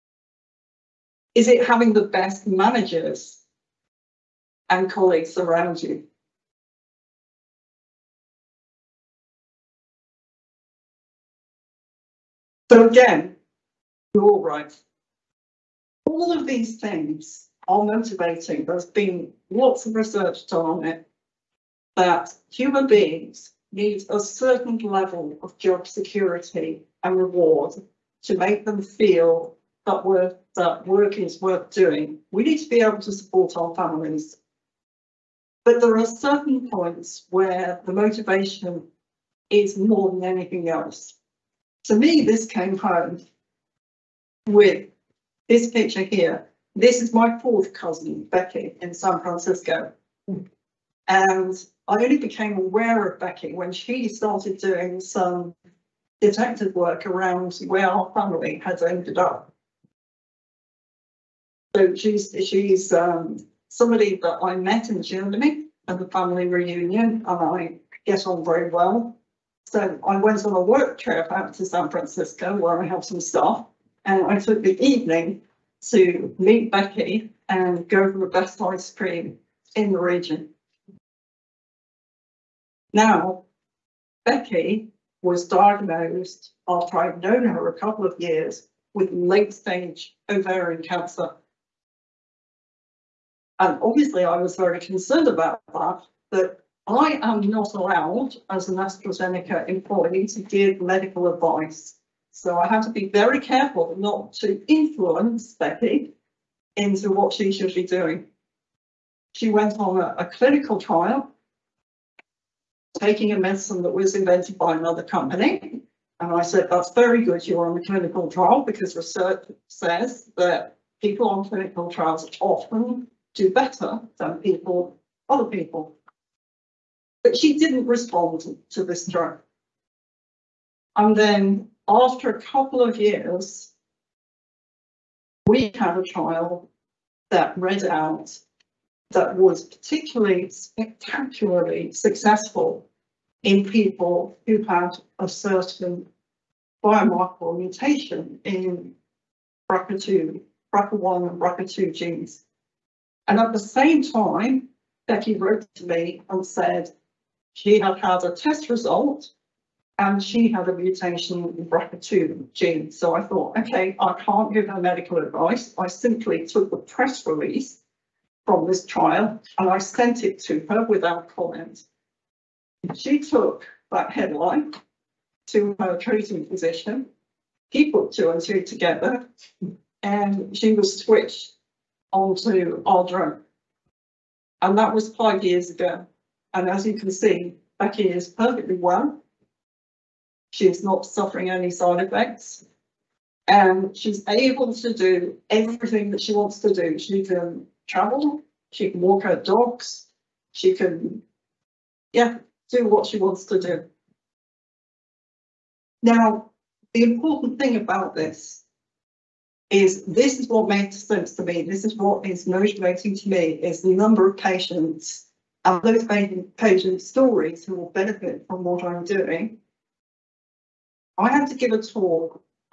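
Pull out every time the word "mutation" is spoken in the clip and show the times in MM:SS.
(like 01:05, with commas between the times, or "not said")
02:27, 02:40.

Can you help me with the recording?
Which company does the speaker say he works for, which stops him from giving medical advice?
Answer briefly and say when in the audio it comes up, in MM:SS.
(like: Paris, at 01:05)
AstraZeneca, at 01:38.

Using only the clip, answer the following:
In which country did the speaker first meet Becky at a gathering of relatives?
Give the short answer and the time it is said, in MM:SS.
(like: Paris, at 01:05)
Germany, at 01:05.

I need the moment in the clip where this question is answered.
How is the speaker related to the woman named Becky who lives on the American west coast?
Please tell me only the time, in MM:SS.
00:47.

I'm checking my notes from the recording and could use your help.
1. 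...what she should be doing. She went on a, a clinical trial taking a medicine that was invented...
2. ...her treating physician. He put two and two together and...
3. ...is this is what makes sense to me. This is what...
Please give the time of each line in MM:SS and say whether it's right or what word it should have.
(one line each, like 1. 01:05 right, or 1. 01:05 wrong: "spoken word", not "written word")
1. 01:47 right
2. 02:55 right
3. 03:29 right.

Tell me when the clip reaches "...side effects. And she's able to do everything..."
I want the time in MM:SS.
03:11.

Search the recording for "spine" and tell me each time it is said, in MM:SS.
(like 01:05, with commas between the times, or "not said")
not said.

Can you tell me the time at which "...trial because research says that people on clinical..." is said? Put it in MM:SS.
01:58.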